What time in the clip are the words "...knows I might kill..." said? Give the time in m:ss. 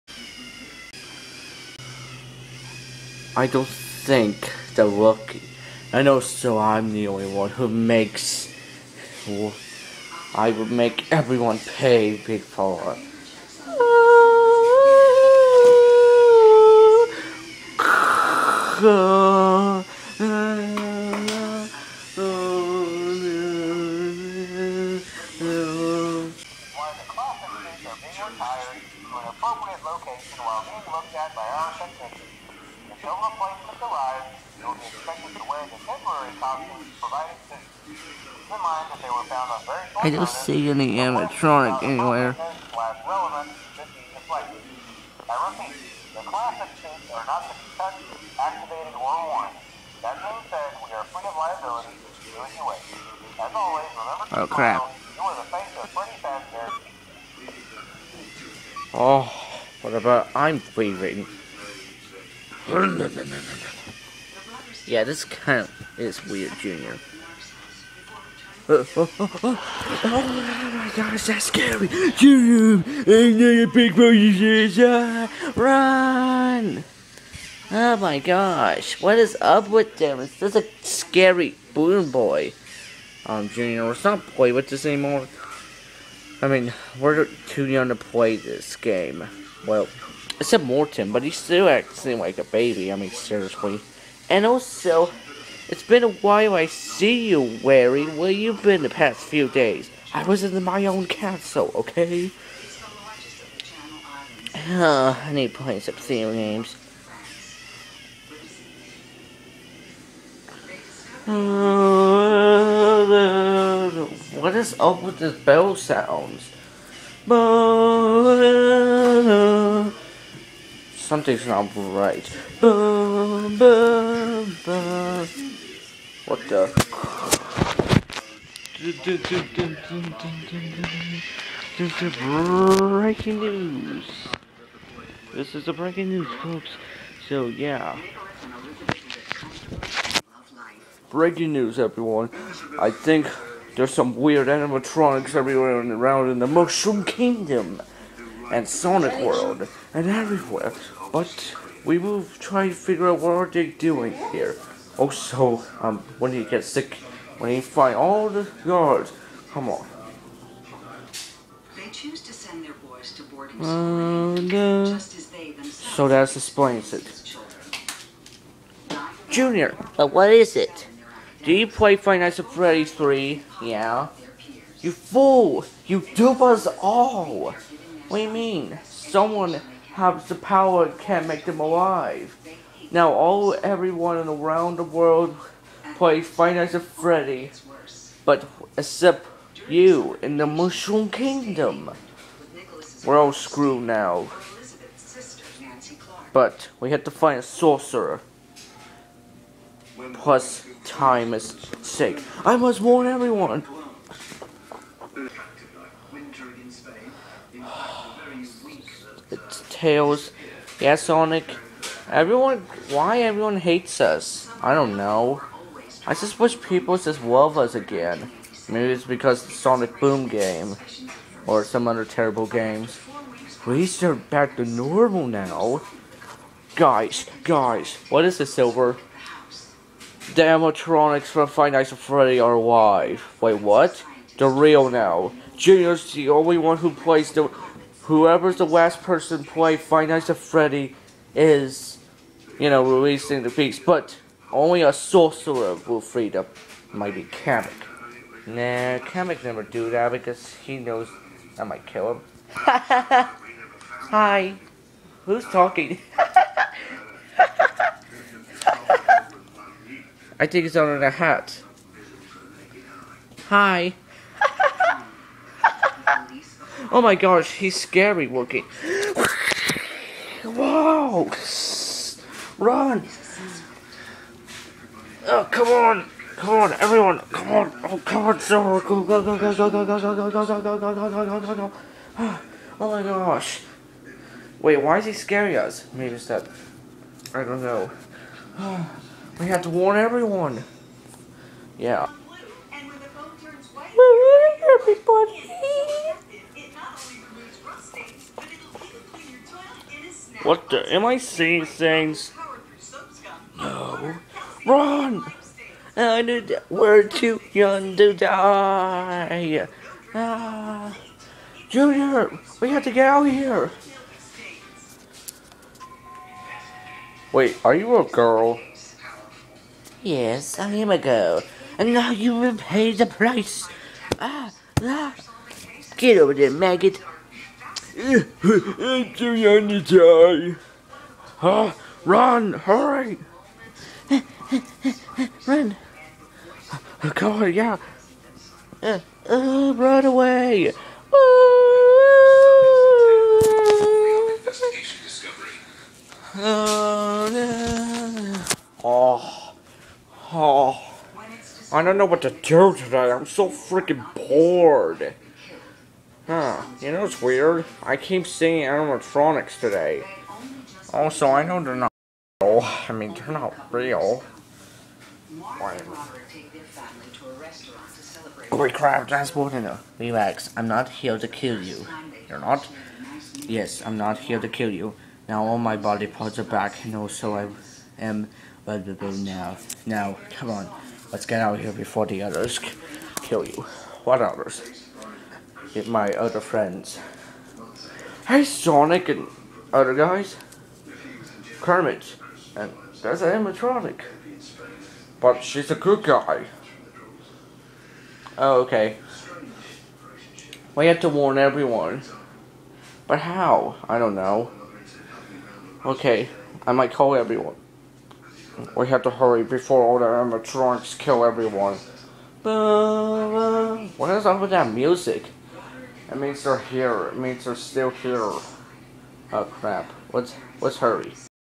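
4:10.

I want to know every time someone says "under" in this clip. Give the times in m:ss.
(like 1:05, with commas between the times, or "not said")
4:20.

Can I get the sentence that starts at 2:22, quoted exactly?
I think there's some weird animatronics everywhere around in the Mushroom Kingdom and Sonic World and everywhere.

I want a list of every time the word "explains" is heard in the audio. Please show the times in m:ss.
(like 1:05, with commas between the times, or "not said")
2:46.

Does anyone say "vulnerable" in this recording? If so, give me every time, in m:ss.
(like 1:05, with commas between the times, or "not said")
6:18.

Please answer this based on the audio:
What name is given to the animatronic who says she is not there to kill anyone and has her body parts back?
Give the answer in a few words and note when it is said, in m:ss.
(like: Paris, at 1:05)
Bortina, at 6:09.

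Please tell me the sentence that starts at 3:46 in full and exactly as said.
Guys, guys, what is this, Silver?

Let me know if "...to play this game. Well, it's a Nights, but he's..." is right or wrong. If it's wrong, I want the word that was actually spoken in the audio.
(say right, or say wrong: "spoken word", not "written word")
wrong: "Morton", not "Nights".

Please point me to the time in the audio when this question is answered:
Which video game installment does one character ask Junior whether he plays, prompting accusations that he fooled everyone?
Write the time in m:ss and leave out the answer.
2:51.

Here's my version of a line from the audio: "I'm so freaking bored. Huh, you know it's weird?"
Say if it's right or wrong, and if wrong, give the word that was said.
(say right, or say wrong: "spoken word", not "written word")
right.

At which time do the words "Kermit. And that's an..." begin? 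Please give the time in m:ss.
6:31.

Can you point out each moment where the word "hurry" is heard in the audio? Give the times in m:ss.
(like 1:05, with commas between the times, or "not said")
5:32, 6:49, 7:00.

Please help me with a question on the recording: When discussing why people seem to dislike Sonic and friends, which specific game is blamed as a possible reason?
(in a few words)
Sonic Boom.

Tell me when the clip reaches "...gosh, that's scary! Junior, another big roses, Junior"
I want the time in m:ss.
1:10.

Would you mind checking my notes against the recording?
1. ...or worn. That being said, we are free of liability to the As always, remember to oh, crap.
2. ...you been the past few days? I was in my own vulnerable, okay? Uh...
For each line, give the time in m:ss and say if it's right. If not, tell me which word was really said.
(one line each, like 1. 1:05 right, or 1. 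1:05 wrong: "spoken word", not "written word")
1. 0:48 right
2. 1:38 wrong: "castle", not "vulnerable".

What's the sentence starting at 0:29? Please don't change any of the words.
Location while being looked at by our technicians no replacements arrived, will be expected to wear the temporary costumes provided soon.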